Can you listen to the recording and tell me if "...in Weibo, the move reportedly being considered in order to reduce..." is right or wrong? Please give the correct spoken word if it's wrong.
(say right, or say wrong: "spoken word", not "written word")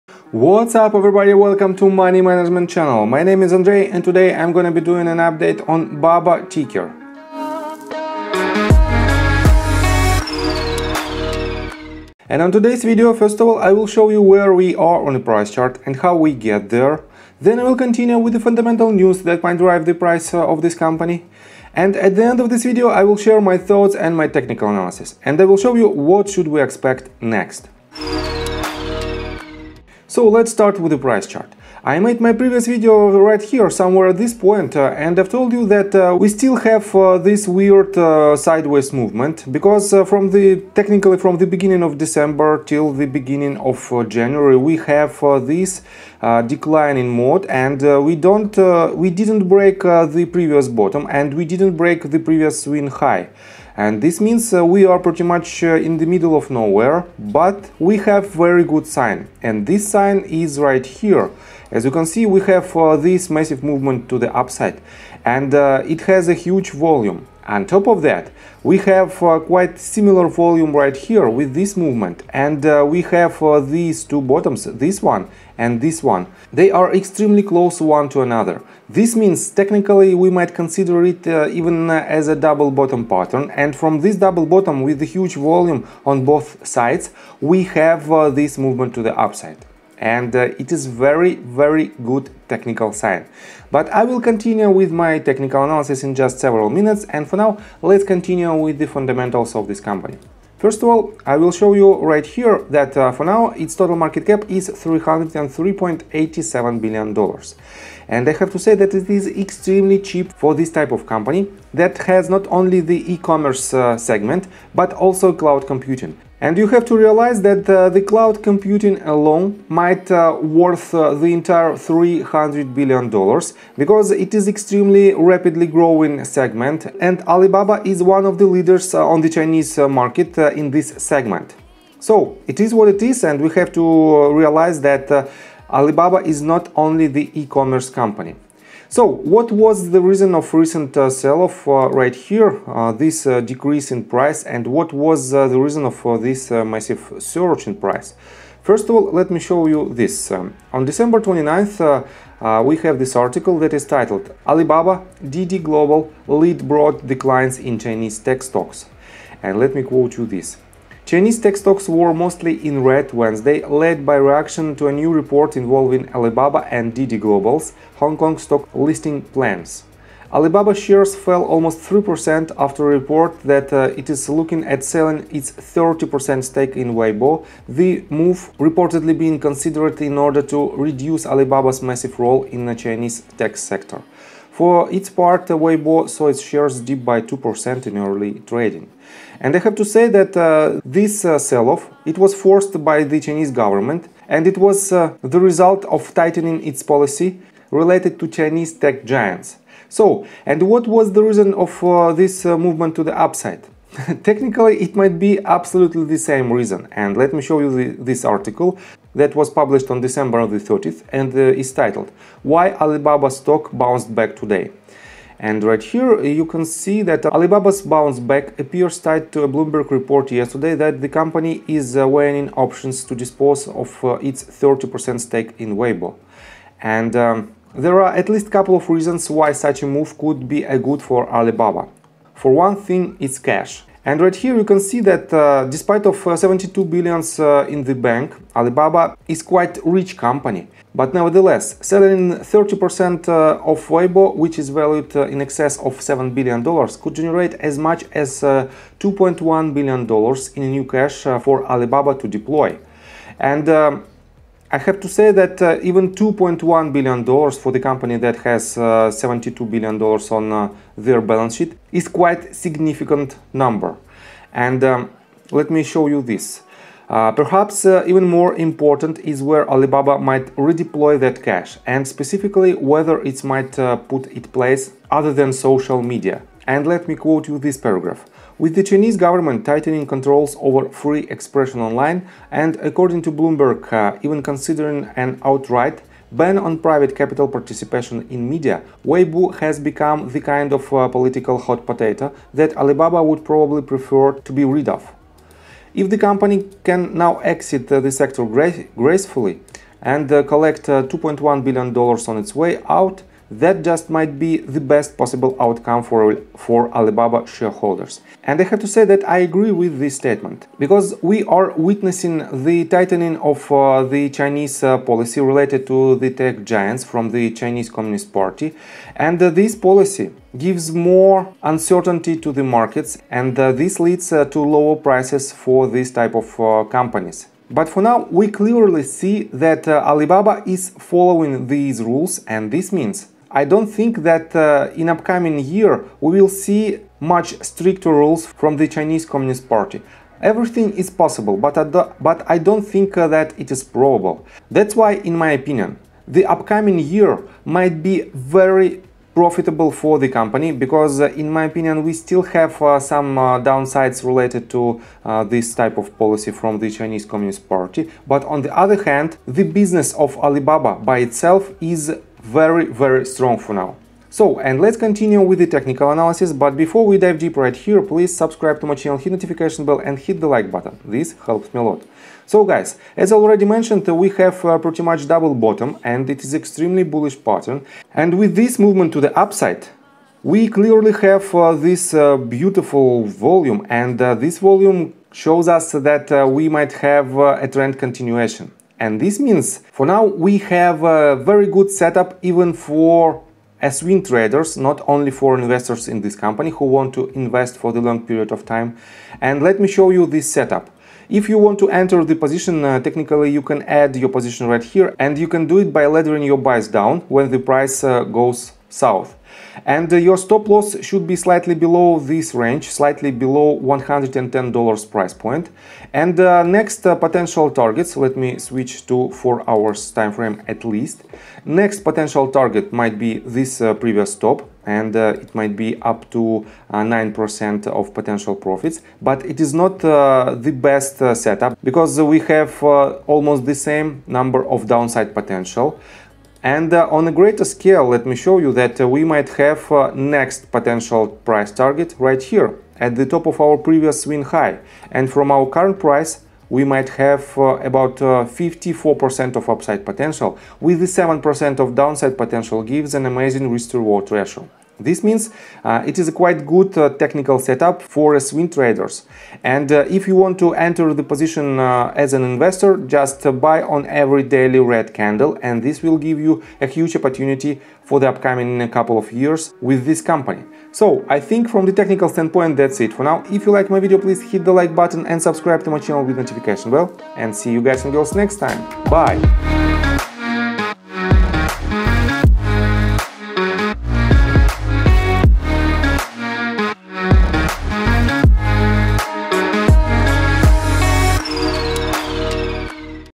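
right.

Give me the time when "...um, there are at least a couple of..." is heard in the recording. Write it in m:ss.
3:47.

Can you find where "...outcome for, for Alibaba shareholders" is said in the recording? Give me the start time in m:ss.
5:05.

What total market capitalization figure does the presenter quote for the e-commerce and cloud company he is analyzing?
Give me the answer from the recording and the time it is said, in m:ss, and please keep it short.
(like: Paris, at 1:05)
$303.87 billion, at 1:44.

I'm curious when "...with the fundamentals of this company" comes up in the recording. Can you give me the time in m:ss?
1:38.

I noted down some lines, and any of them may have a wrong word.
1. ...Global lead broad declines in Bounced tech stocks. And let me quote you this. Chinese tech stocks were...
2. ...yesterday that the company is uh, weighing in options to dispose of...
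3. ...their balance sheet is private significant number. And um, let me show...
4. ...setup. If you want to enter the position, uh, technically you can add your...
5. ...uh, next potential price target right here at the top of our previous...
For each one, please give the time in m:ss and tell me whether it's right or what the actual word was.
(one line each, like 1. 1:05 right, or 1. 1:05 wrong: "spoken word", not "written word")
1. 2:35 wrong: "Chinese", not "Bounced"
2. 3:40 right
3. 4:20 wrong: "quite", not "private"
4. 6:40 right
5. 7:19 right.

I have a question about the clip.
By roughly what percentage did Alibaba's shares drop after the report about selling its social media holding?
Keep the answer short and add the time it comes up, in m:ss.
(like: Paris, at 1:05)
almost 3%, at 2:51.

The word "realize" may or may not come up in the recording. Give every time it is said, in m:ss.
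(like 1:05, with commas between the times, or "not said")
1:56, 2:14.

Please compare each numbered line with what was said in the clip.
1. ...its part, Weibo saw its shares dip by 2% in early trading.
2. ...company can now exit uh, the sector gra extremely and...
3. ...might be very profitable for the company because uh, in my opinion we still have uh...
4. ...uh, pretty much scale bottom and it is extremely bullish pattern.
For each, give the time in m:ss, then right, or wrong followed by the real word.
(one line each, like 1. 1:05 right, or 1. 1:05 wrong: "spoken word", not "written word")
1. 3:04 right
2. 4:56 wrong: "gracefully", not "extremely"
3. 5:47 right
4. 6:14 wrong: "double", not "scale".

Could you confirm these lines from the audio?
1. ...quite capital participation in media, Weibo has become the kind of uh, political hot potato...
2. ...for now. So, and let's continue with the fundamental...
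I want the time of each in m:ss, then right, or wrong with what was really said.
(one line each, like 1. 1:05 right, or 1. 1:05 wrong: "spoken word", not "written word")
1. 4:46 wrong: "private", not "quite"
2. 6:03 wrong: "technical", not "fundamental".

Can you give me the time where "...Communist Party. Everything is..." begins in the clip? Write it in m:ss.
5:39.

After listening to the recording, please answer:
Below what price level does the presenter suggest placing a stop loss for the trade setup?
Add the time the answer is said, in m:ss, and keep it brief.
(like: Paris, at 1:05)
$110, at 6:53.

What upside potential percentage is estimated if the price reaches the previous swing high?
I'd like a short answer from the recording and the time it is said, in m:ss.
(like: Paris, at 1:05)
54%, at 7:28.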